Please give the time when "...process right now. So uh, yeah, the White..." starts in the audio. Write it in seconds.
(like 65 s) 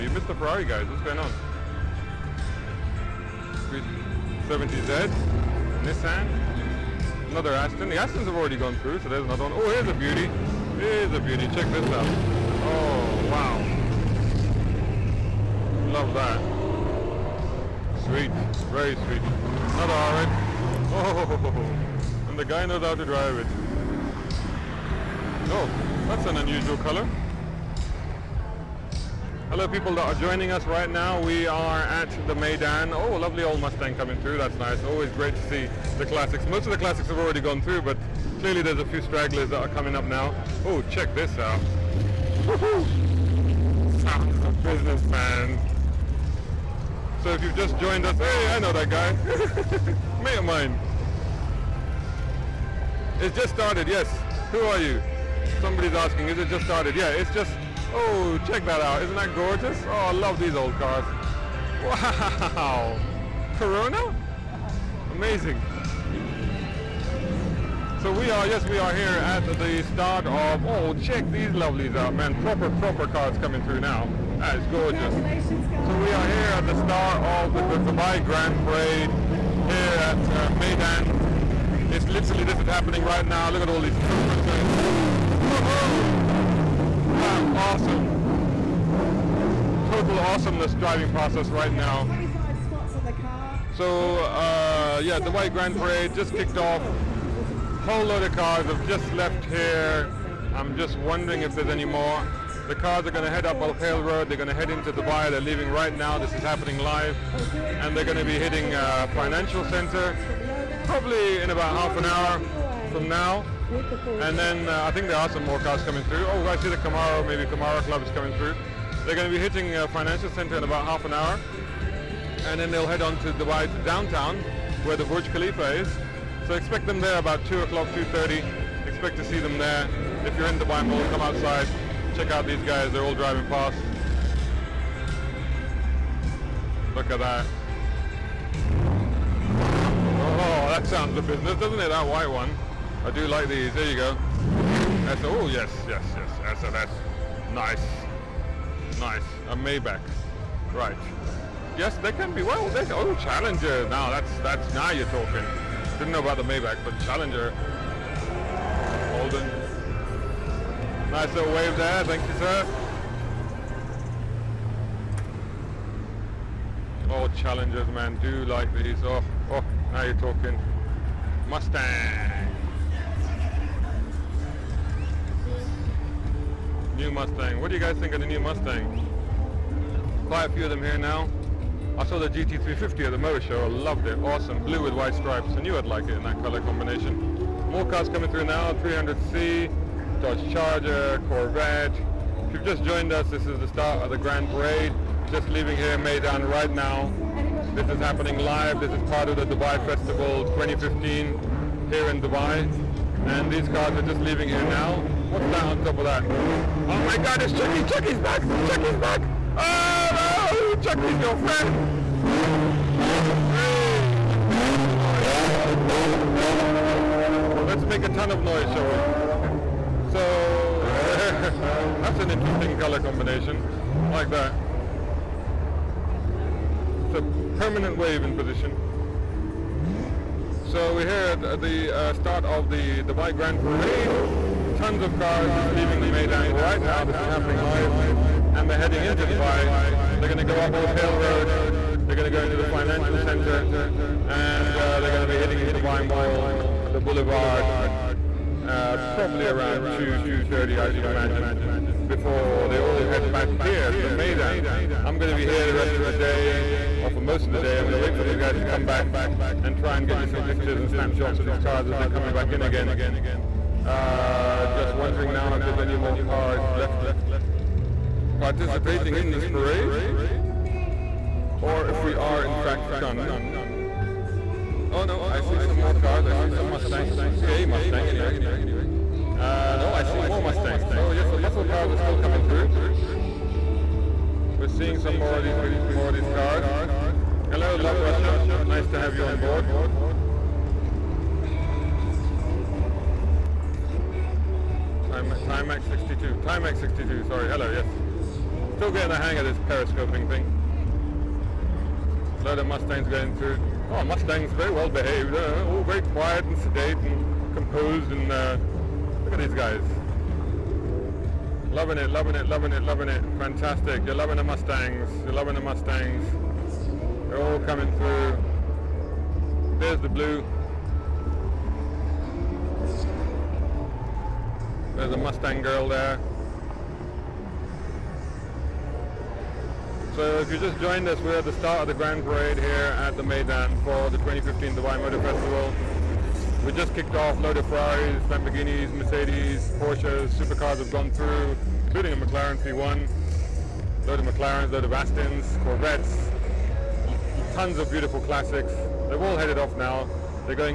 91 s.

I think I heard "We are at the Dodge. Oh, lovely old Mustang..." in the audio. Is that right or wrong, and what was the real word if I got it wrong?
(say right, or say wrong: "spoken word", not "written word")
wrong: "Meydan", not "Dodge".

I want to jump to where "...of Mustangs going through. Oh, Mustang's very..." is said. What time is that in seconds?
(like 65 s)
302 s.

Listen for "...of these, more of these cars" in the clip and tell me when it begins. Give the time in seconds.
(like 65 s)
285 s.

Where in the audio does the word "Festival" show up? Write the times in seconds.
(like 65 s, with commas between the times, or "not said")
199 s, 335 s.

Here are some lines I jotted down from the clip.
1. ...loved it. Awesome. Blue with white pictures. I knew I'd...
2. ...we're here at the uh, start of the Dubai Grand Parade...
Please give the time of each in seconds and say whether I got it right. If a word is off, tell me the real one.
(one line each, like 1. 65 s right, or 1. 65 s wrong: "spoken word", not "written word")
1. 183 s wrong: "stripes", not "pictures"
2. 230 s right.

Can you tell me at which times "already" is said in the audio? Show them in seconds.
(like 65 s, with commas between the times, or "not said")
8 s, 37 s.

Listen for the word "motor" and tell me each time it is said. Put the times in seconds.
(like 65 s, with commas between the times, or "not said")
183 s, 334 s.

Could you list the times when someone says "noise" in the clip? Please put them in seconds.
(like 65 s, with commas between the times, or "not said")
218 s.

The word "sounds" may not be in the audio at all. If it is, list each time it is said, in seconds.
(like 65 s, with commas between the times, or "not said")
44 s, 140 s.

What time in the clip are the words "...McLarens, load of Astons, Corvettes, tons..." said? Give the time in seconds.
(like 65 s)
344 s.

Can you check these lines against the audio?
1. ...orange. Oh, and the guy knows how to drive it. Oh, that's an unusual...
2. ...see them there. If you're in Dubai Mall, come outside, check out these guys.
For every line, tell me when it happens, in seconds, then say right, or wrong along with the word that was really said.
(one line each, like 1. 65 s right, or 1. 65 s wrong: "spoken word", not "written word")
1. 20 s right
2. 129 s right.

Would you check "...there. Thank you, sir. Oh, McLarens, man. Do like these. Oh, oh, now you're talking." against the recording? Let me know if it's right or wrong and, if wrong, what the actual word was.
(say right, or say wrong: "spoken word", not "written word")
wrong: "Challengers", not "McLarens".